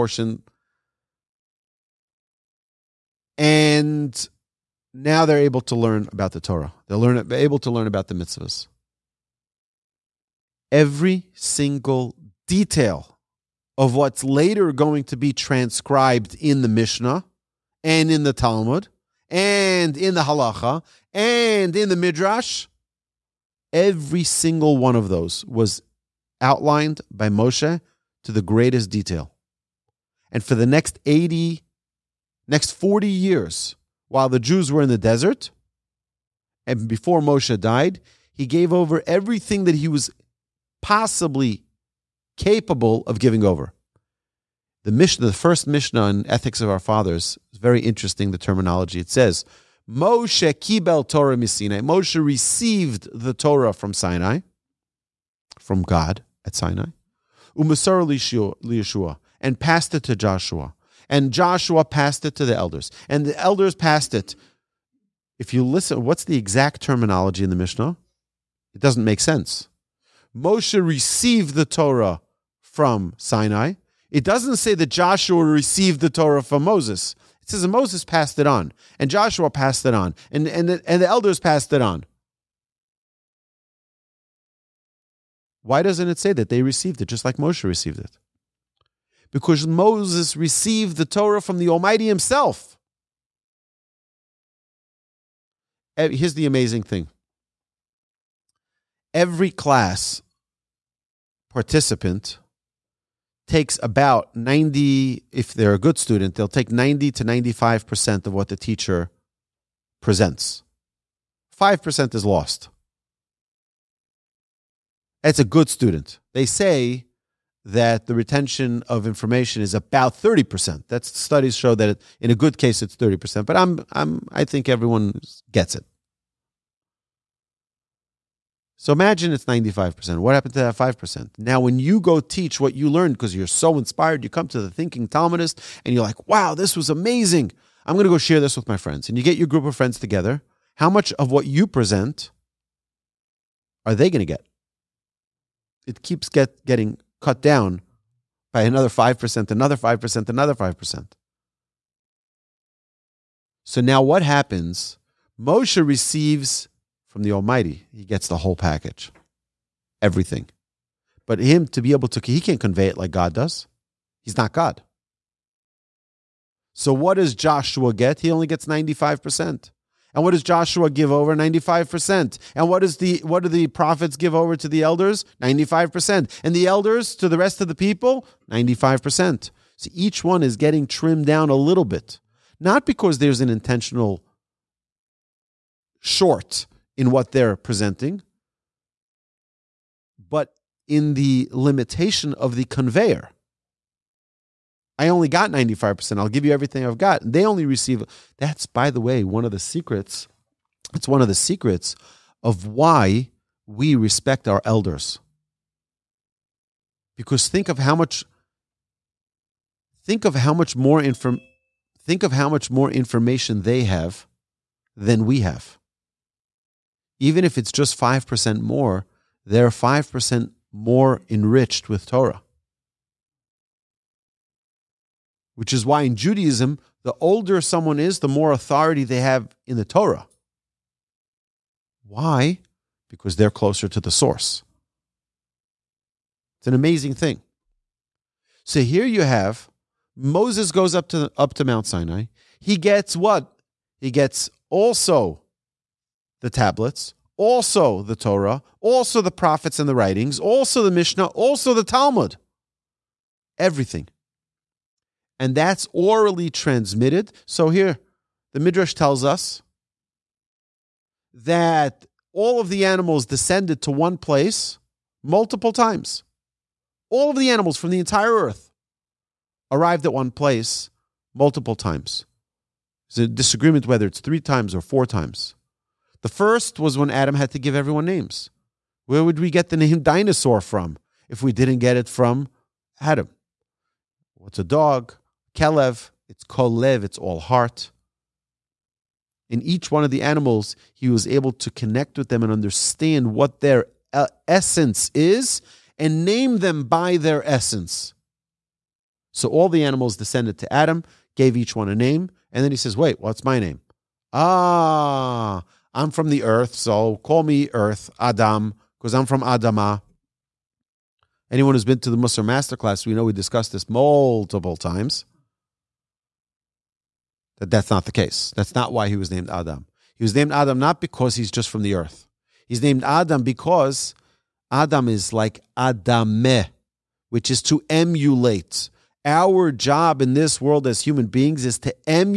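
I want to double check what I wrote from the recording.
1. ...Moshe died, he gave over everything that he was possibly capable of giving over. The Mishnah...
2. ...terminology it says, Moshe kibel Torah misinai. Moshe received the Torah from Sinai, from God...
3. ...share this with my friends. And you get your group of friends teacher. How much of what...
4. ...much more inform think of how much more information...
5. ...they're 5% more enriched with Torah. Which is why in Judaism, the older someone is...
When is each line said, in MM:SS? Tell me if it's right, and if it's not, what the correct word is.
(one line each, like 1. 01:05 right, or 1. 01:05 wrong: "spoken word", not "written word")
1. 00:37 right
2. 00:48 right
3. 02:18 wrong: "together", not "teacher"
4. 03:30 right
5. 03:39 right.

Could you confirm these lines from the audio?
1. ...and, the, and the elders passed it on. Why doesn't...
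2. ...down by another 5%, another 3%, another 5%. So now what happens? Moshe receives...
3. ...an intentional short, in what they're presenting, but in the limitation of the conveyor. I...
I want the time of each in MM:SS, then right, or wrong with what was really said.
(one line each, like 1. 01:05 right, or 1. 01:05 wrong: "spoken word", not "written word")
1. 01:20 right
2. 02:27 wrong: "5", not "3"
3. 03:03 right.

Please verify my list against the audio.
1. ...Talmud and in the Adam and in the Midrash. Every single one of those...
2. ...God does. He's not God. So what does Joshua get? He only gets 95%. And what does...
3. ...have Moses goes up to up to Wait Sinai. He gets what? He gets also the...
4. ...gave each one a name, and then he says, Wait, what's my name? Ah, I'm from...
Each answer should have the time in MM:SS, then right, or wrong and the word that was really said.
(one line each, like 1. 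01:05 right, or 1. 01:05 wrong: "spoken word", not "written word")
1. 00:18 wrong: "Halacha", not "Adam"
2. 02:43 right
3. 03:59 wrong: "Mount", not "Wait"
4. 05:01 right.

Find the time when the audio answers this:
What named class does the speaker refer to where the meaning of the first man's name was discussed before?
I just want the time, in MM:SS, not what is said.
05:12.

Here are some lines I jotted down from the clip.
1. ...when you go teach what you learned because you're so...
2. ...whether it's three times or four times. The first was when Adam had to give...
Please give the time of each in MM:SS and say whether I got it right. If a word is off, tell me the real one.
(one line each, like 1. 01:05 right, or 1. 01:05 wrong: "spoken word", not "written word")
1. 02:11 right
2. 04:33 right.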